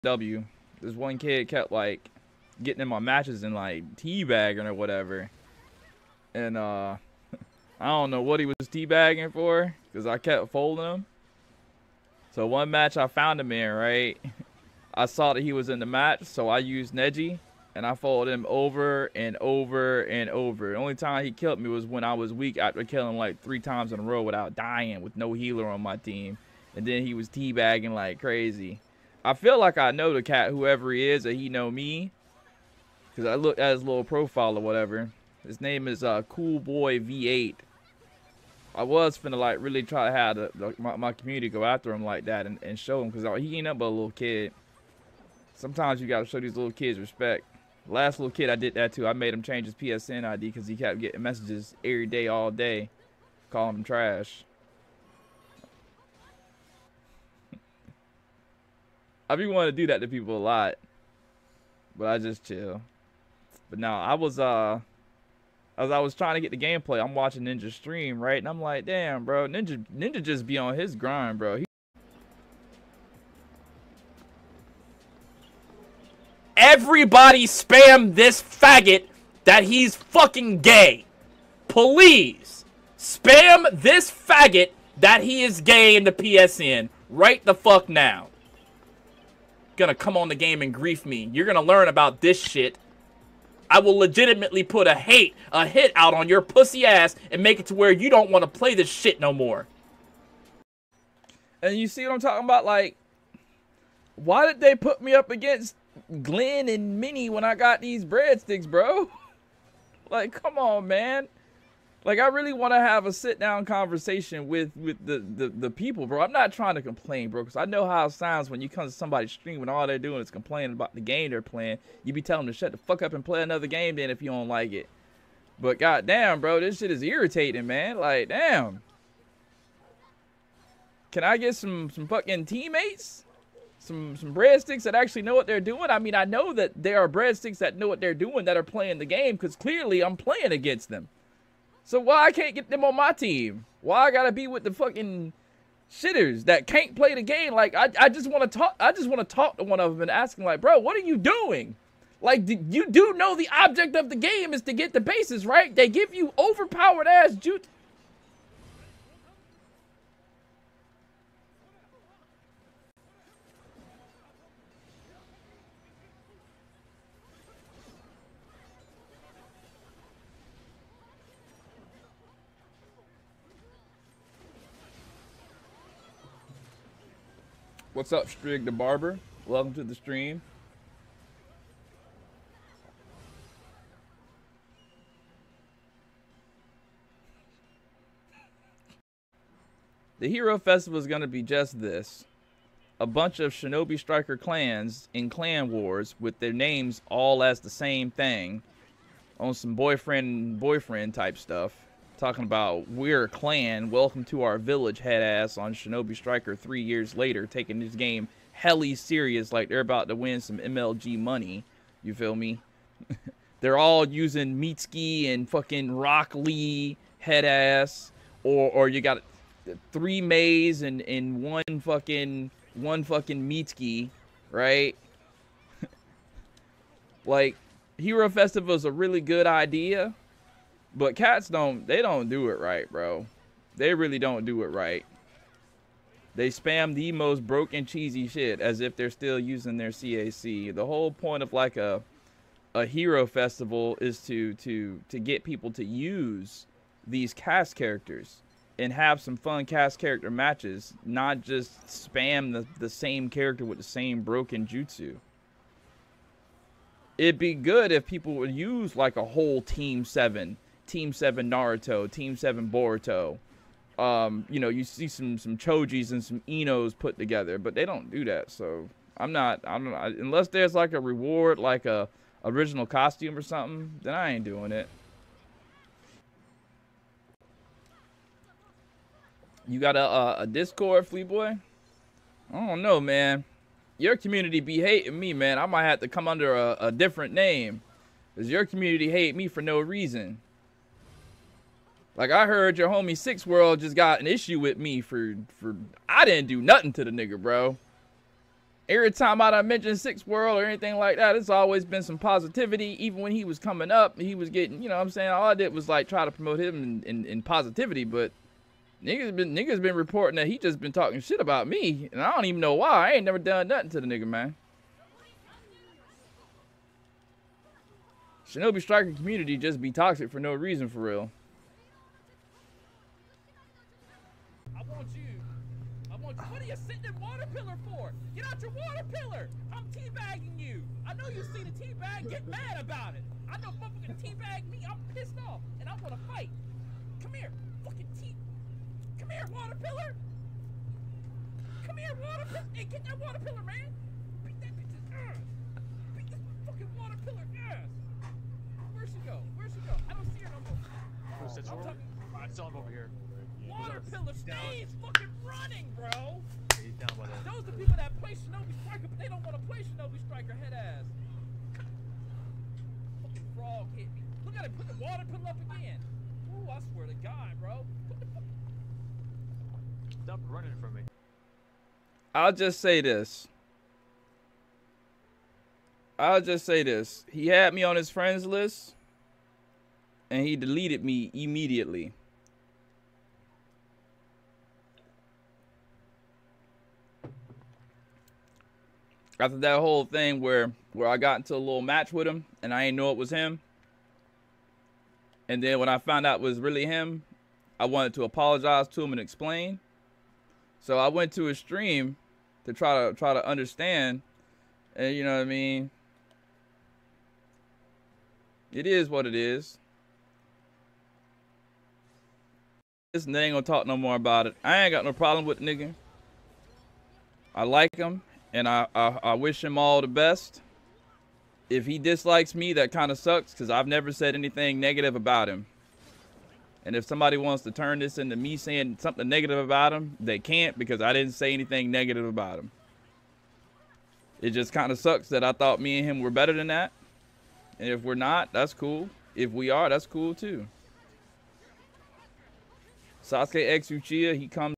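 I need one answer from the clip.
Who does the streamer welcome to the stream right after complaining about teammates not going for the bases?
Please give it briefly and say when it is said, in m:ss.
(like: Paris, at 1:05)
Strig the Barber, at 2:58.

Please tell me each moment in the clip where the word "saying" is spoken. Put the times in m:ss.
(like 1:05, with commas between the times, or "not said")
5:05, 7:08.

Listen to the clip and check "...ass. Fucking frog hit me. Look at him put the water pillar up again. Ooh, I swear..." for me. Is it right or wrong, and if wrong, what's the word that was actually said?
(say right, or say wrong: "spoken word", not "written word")
right.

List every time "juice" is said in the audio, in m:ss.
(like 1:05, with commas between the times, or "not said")
2:37.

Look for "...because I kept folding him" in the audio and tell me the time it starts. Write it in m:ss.
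0:09.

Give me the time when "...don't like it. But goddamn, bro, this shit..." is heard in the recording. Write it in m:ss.
2:04.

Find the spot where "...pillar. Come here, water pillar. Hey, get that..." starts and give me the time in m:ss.
5:39.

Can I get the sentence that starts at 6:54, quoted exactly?
I ain't got no problem with the nigga.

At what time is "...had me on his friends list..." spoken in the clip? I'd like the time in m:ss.
6:17.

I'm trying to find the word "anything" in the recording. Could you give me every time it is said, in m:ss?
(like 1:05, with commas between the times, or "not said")
5:00, 7:04, 7:11.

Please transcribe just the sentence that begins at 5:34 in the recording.
I'm pissed off and I'm gonna fight.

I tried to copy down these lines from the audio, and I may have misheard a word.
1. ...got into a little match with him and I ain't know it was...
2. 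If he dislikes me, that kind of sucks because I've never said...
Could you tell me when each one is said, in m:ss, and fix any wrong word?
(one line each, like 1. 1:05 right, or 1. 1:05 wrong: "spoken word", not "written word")
1. 6:31 right
2. 7:01 right.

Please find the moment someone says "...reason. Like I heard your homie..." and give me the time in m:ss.
4:49.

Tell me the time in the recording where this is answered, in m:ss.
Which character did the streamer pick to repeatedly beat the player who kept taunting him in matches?
0:16.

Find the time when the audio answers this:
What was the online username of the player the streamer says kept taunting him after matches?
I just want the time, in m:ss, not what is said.
0:36.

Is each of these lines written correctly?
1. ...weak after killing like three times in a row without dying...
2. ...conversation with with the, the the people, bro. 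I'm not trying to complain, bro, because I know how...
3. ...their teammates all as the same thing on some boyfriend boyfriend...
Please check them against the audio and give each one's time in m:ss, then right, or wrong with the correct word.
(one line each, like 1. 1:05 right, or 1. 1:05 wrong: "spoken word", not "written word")
1. 0:22 right
2. 1:53 right
3. 3:16 wrong: "names", not "teammates".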